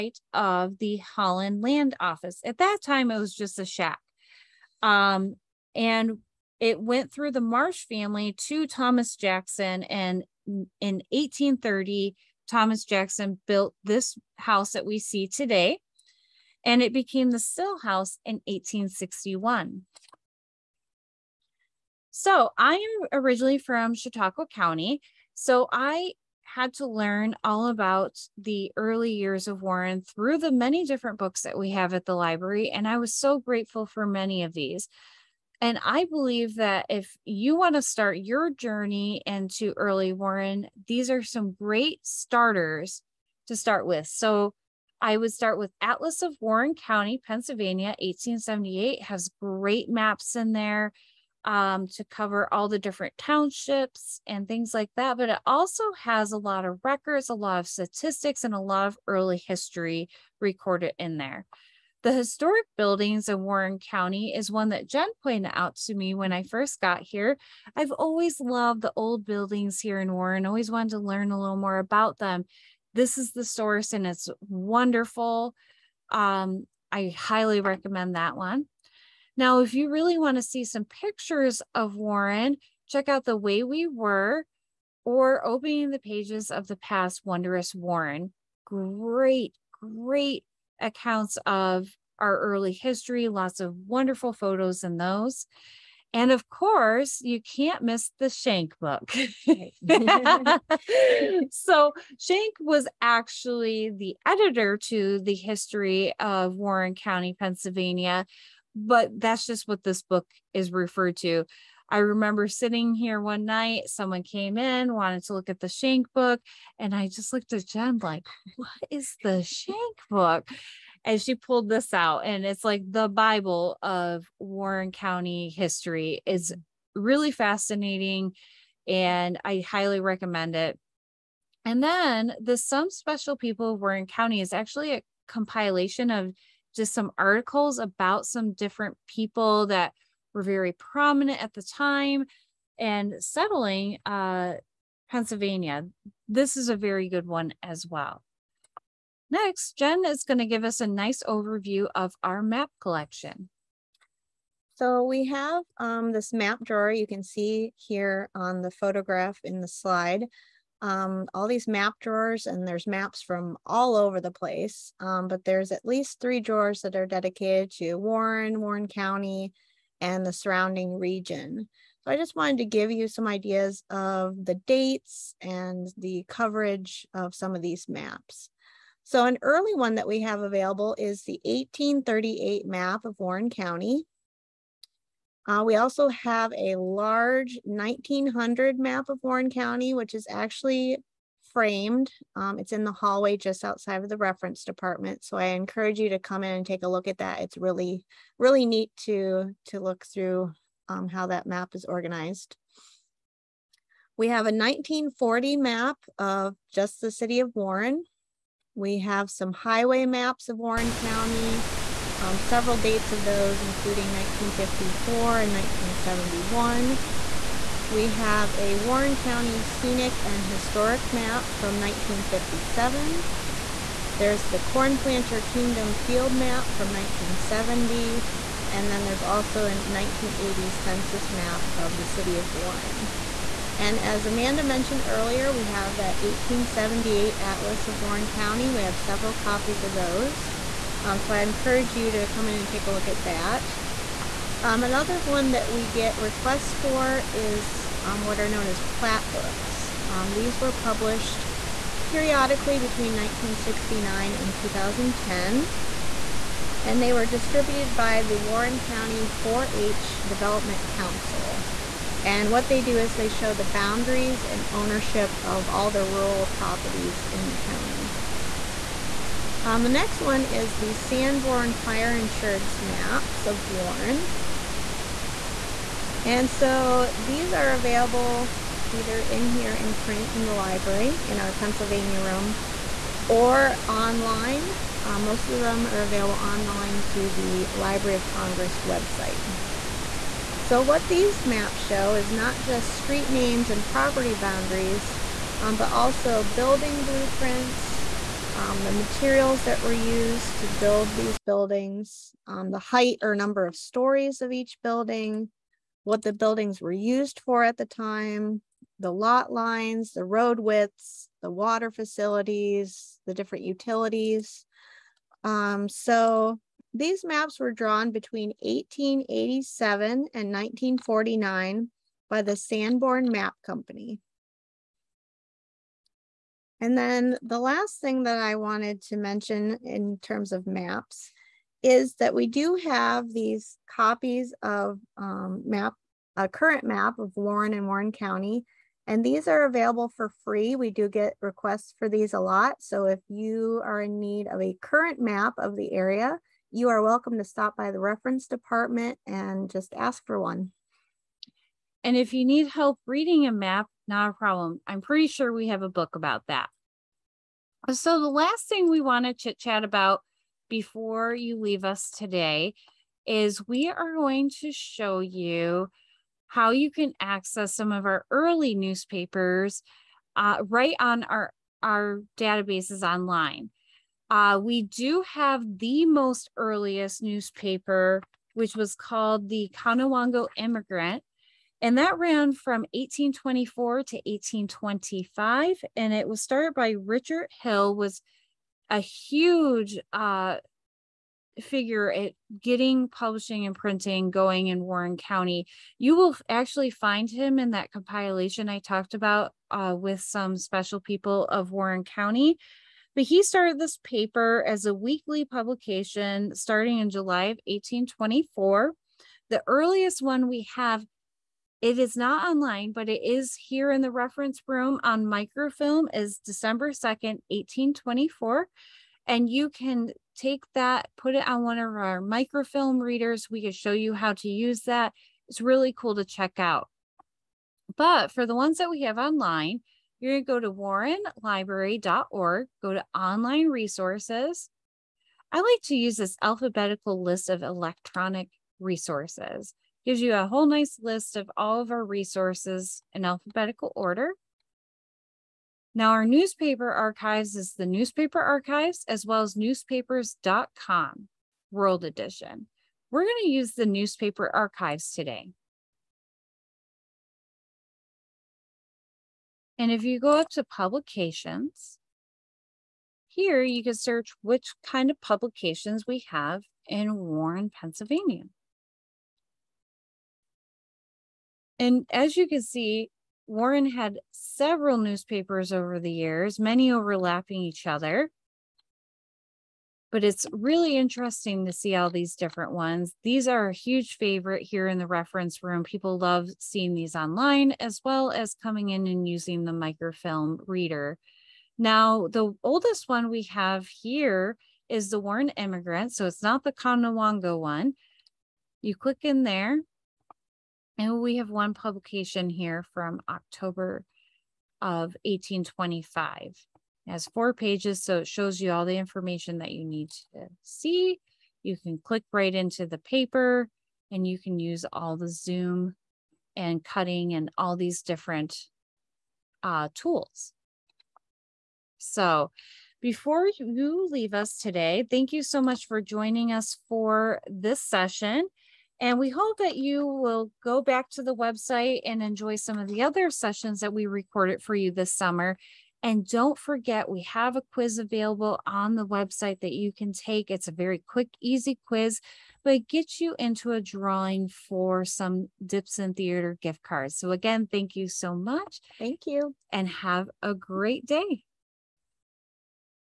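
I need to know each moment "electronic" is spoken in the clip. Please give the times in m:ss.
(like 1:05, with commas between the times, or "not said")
7:17.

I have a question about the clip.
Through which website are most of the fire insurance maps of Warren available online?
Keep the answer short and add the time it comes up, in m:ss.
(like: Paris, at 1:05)
Library of Congress, at 4:47.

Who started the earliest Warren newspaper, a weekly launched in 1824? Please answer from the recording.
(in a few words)
Richard Hill.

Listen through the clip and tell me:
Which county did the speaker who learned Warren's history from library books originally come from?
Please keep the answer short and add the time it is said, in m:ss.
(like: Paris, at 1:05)
Chautauqua County, at 0:23.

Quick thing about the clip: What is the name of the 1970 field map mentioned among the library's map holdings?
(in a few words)
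Cornplanter Kingdom.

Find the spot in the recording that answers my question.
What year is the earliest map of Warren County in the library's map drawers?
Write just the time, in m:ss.
3:01.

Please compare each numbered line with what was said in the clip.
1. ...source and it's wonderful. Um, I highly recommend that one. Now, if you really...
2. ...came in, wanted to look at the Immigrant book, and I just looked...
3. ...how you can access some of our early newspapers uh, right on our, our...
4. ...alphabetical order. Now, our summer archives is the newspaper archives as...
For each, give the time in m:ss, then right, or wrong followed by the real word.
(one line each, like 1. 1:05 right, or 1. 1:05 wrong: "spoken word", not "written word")
1. 1:13 right
2. 1:54 wrong: "Shank", not "Immigrant"
3. 6:06 right
4. 7:23 wrong: "newspaper", not "summer".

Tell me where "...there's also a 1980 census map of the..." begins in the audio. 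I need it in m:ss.
3:49.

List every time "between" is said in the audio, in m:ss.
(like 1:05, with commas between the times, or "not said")
4:12, 5:18.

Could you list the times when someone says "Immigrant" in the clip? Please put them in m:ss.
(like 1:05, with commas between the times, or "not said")
6:20, 8:15.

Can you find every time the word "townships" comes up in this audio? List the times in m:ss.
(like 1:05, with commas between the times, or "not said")
0:53.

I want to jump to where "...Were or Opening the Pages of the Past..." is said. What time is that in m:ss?
1:23.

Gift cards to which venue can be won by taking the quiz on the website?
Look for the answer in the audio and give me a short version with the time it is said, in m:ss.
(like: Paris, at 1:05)
Dipson Theater, at 9:05.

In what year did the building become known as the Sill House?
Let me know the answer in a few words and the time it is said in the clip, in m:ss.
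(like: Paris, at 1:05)
1861, at 0:18.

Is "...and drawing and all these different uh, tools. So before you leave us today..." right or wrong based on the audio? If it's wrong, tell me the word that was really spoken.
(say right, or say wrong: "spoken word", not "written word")
wrong: "cutting", not "drawing".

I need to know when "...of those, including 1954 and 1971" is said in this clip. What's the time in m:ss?
3:33.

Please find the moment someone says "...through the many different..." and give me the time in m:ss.
0:30.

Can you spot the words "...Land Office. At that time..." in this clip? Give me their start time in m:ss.
0:01.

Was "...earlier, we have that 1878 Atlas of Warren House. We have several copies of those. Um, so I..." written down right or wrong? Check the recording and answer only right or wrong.
wrong.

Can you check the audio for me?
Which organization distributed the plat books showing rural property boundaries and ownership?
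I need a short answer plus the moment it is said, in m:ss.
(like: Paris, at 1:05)
Warren County 4 H Development Council, at 4:18.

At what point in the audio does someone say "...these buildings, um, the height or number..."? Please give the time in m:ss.
5:01.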